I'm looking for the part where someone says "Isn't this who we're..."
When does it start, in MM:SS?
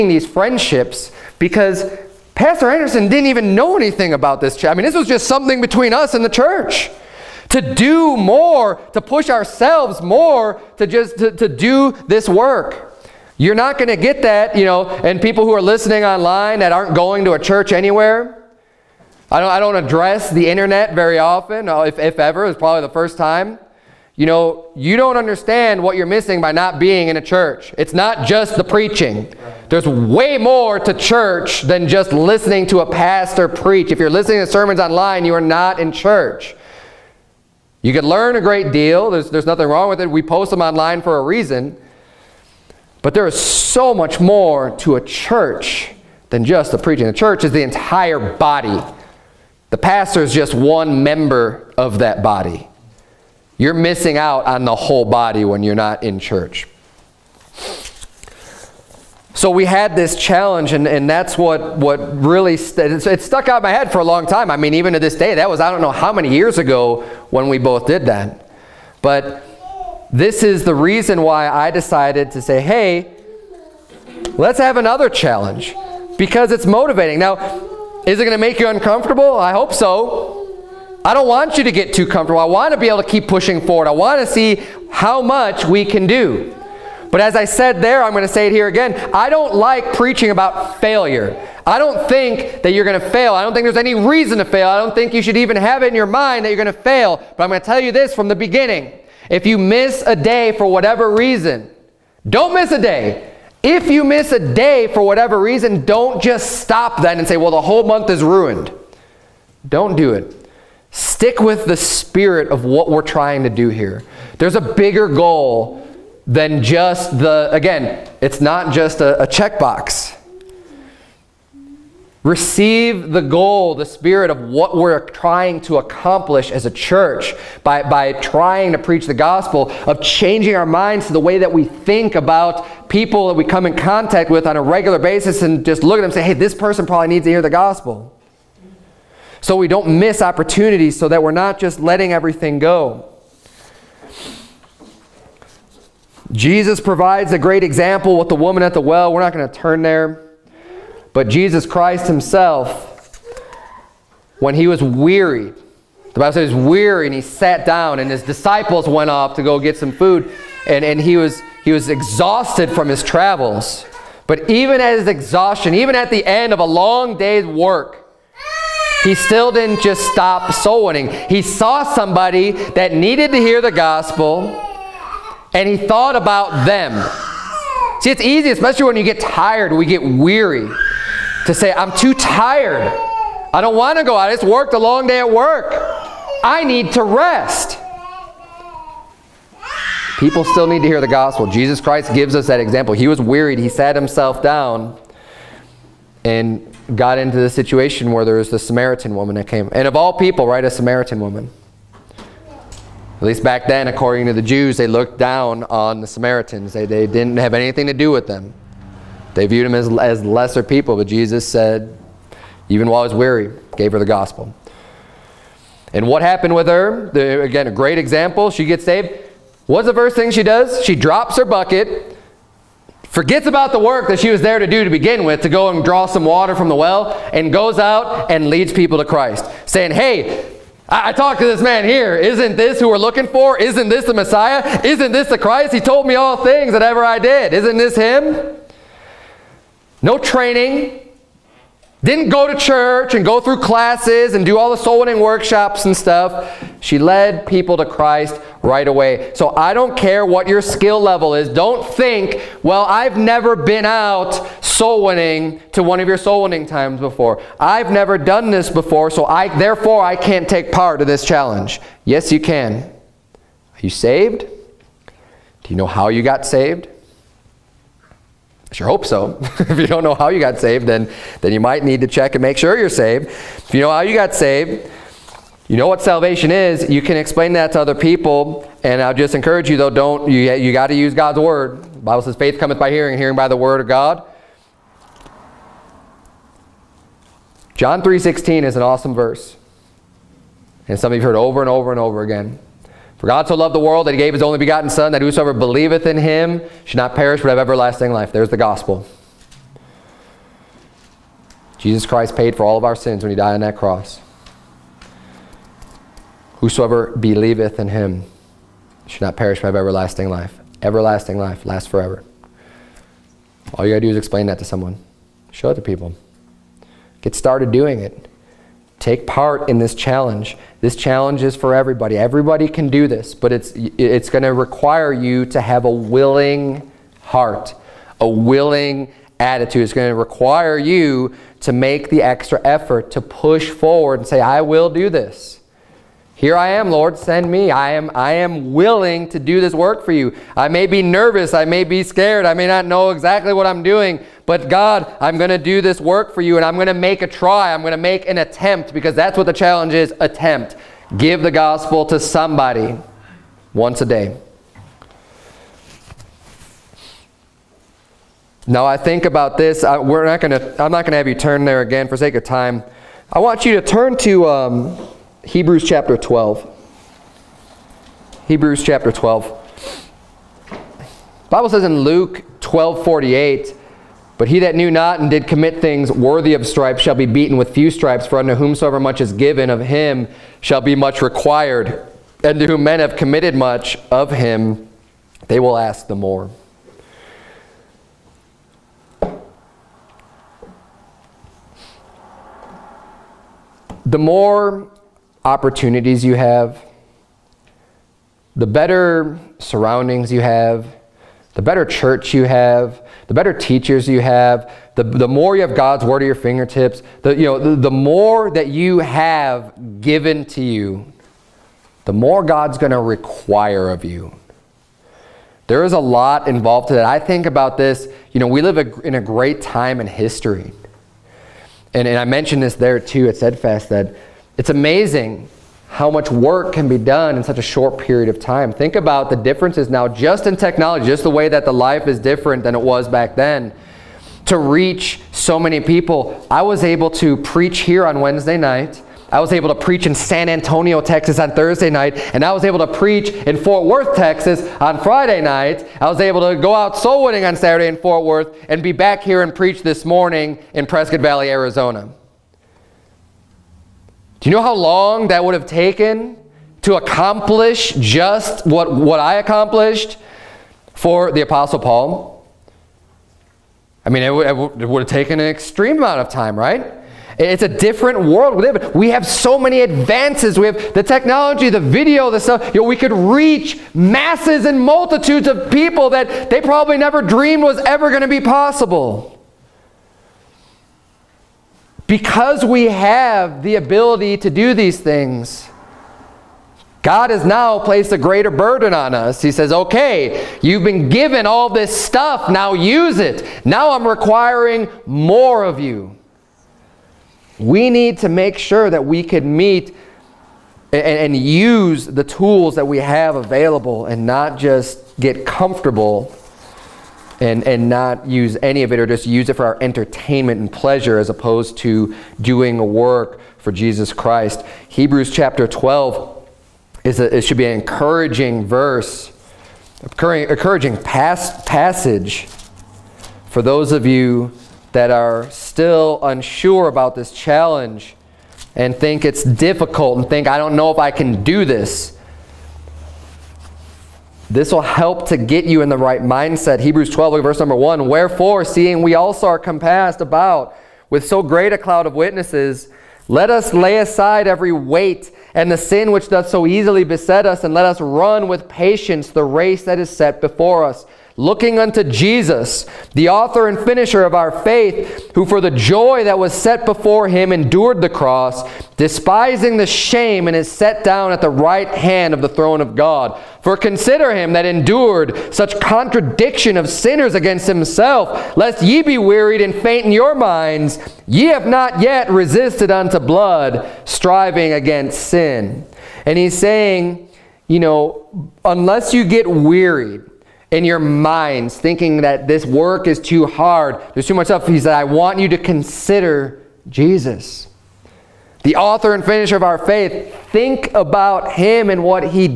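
03:52.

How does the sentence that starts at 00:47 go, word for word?
The church is the entire body.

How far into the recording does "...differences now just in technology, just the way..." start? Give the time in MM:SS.
07:09.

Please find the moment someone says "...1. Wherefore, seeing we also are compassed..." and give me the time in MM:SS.
08:57.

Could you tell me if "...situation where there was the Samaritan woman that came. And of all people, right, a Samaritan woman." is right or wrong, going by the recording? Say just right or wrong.
right.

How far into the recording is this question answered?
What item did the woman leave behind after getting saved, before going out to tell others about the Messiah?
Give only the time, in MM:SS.
03:41.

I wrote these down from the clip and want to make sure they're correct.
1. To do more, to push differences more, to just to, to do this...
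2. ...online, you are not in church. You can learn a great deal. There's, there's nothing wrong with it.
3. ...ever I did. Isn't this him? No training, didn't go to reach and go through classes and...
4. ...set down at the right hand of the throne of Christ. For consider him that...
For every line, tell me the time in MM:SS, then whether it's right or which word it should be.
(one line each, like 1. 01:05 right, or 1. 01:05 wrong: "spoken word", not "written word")
1. 00:07 wrong: "ourselves", not "differences"
2. 00:34 right
3. 03:56 wrong: "church", not "reach"
4. 09:20 wrong: "God", not "Christ".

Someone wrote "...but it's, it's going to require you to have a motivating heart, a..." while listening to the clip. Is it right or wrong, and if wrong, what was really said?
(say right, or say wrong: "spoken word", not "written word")
wrong: "willing", not "motivating".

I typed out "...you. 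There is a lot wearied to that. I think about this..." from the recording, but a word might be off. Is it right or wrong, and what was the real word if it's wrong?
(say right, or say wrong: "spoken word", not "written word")
wrong: "involved", not "wearied".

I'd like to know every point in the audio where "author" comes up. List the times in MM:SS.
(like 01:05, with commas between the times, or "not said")
09:13, 09:48.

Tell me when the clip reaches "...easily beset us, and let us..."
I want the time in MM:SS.
09:06.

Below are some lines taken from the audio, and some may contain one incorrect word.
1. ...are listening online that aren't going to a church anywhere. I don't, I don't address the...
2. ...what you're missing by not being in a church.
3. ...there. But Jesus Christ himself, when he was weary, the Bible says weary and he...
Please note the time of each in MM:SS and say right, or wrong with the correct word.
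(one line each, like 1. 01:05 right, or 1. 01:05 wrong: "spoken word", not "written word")
1. 00:15 right
2. 00:25 right
3. 02:29 right.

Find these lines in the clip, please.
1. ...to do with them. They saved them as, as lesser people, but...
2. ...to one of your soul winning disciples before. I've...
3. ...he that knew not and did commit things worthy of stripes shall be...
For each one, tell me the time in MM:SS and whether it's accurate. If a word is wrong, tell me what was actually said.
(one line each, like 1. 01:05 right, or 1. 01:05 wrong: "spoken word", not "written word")
1. 03:27 wrong: "viewed", not "saved"
2. 04:15 wrong: "times", not "disciples"
3. 06:14 right.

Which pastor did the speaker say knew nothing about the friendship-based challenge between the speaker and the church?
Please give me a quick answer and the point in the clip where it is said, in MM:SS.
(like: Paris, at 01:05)
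Pastor Anderson, at 00:02.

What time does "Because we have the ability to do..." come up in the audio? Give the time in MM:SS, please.
08:02.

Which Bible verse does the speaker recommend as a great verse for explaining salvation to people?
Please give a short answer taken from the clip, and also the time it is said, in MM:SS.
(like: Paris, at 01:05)
John 3:16, at 04:47.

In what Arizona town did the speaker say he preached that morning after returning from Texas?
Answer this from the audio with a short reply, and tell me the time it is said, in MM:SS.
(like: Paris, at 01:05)
Prescott Valley, at 07:30.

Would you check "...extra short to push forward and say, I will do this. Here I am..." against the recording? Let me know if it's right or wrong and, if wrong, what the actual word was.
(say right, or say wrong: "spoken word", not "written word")
wrong: "effort", not "short".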